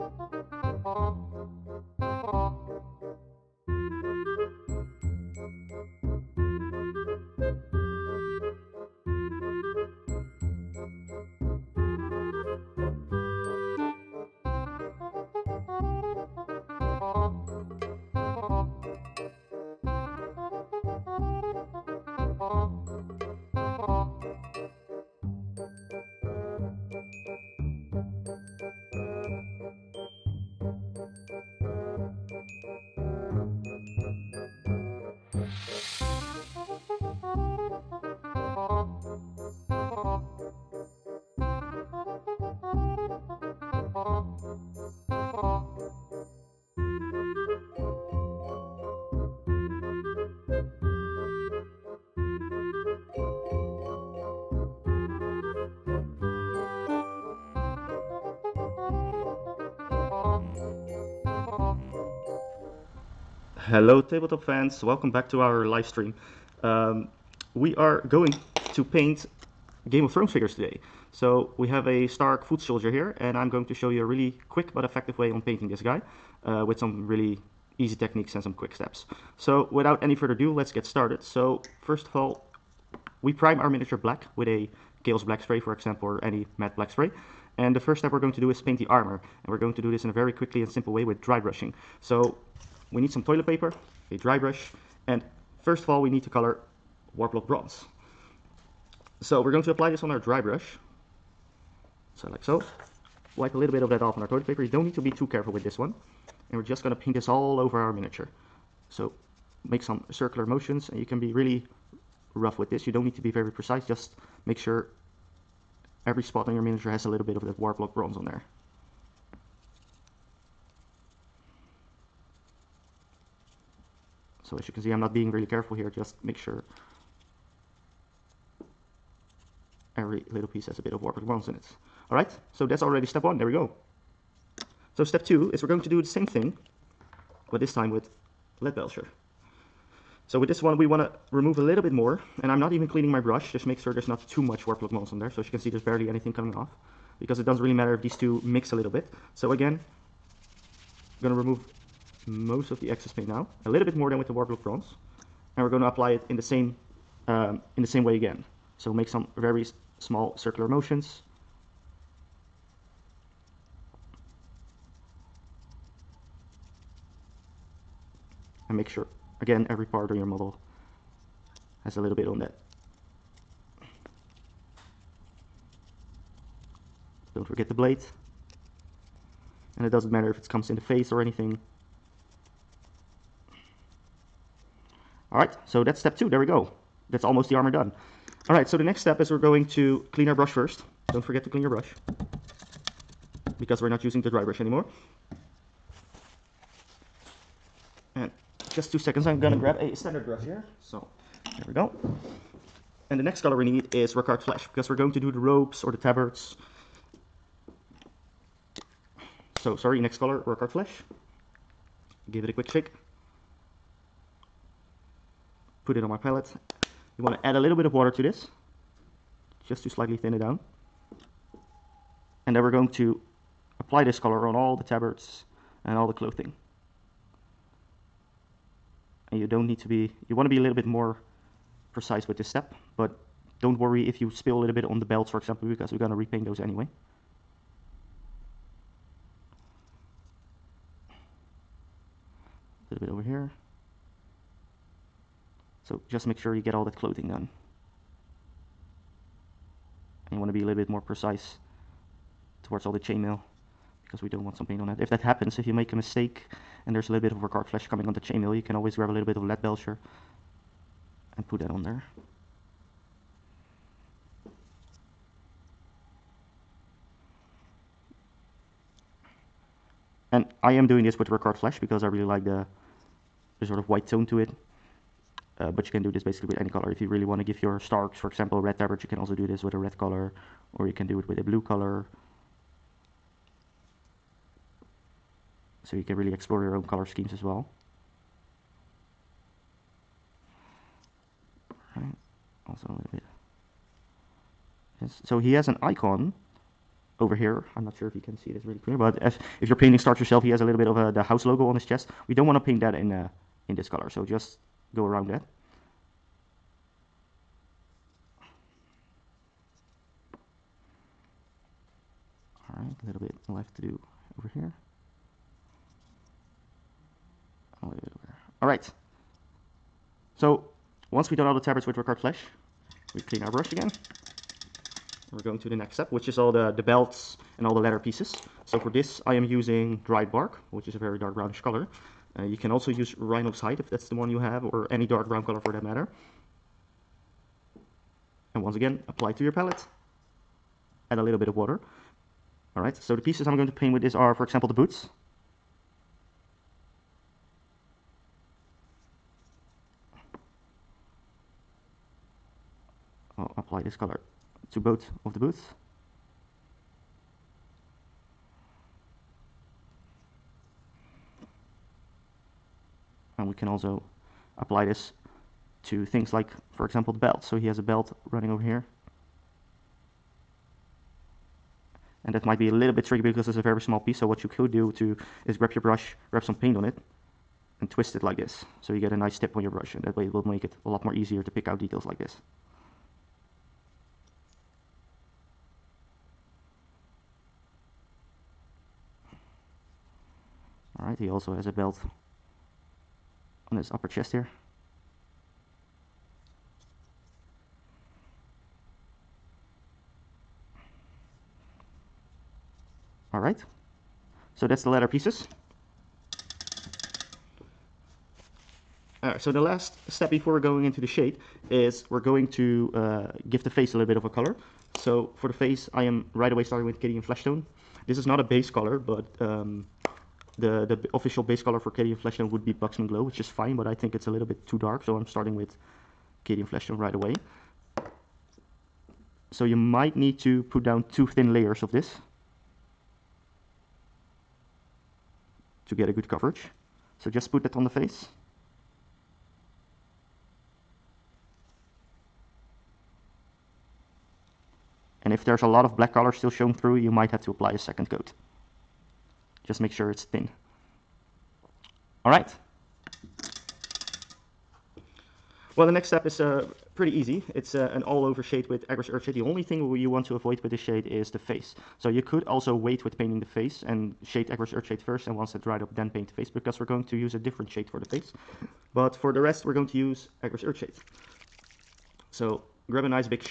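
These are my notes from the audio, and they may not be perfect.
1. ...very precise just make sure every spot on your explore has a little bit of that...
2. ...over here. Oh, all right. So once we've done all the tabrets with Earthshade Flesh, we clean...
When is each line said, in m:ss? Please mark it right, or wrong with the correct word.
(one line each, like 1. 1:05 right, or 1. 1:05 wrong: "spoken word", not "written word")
1. 1:53 wrong: "miniature", not "explore"
2. 5:14 wrong: "Rakarth", not "Earthshade".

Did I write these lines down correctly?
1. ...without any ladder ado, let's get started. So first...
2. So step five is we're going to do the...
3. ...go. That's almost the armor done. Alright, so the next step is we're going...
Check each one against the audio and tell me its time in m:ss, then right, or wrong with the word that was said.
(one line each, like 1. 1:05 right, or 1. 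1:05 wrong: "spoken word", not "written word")
1. 1:19 wrong: "further", not "ladder"
2. 2:14 wrong: "two", not "five"
3. 3:06 right.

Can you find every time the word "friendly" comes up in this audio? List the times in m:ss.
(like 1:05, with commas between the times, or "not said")
not said.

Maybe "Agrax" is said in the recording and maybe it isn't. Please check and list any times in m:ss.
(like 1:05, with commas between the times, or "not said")
7:38, 7:44, 7:50.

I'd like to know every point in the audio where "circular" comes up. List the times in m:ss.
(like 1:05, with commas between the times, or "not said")
1:50, 2:40.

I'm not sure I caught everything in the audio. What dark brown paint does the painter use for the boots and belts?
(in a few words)
Dryad Bark.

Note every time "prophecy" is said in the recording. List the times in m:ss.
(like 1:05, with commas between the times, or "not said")
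not said.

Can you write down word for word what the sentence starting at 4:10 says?
And you want to be a little bit more precise towards all the chainmail because we don't want some paint on it.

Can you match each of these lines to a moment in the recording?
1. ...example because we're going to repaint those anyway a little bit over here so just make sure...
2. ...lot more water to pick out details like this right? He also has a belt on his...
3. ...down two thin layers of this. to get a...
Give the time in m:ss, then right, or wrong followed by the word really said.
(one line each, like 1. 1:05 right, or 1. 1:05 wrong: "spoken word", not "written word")
1. 3:55 right
2. 6:20 wrong: "easier", not "water"
3. 7:10 right.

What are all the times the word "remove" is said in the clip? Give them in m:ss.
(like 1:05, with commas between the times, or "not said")
2:21, 2:31.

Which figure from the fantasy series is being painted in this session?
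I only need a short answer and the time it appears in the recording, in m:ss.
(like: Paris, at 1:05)
Stark foot soldier, at 1:12.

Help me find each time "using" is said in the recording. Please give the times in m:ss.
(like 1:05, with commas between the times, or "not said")
3:14, 5:29.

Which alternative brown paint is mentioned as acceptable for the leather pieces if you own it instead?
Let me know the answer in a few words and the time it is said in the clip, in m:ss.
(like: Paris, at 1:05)
Rhinox Hide, at 5:33.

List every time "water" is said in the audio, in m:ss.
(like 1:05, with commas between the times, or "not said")
3:37, 5:41.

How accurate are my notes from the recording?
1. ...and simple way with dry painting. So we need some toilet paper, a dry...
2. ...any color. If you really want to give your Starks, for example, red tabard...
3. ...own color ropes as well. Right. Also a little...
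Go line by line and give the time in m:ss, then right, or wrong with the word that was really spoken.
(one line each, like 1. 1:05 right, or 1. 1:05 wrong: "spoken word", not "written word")
1. 1:30 wrong: "brushing", not "painting"
2. 4:36 right
3. 4:46 wrong: "schemes", not "ropes".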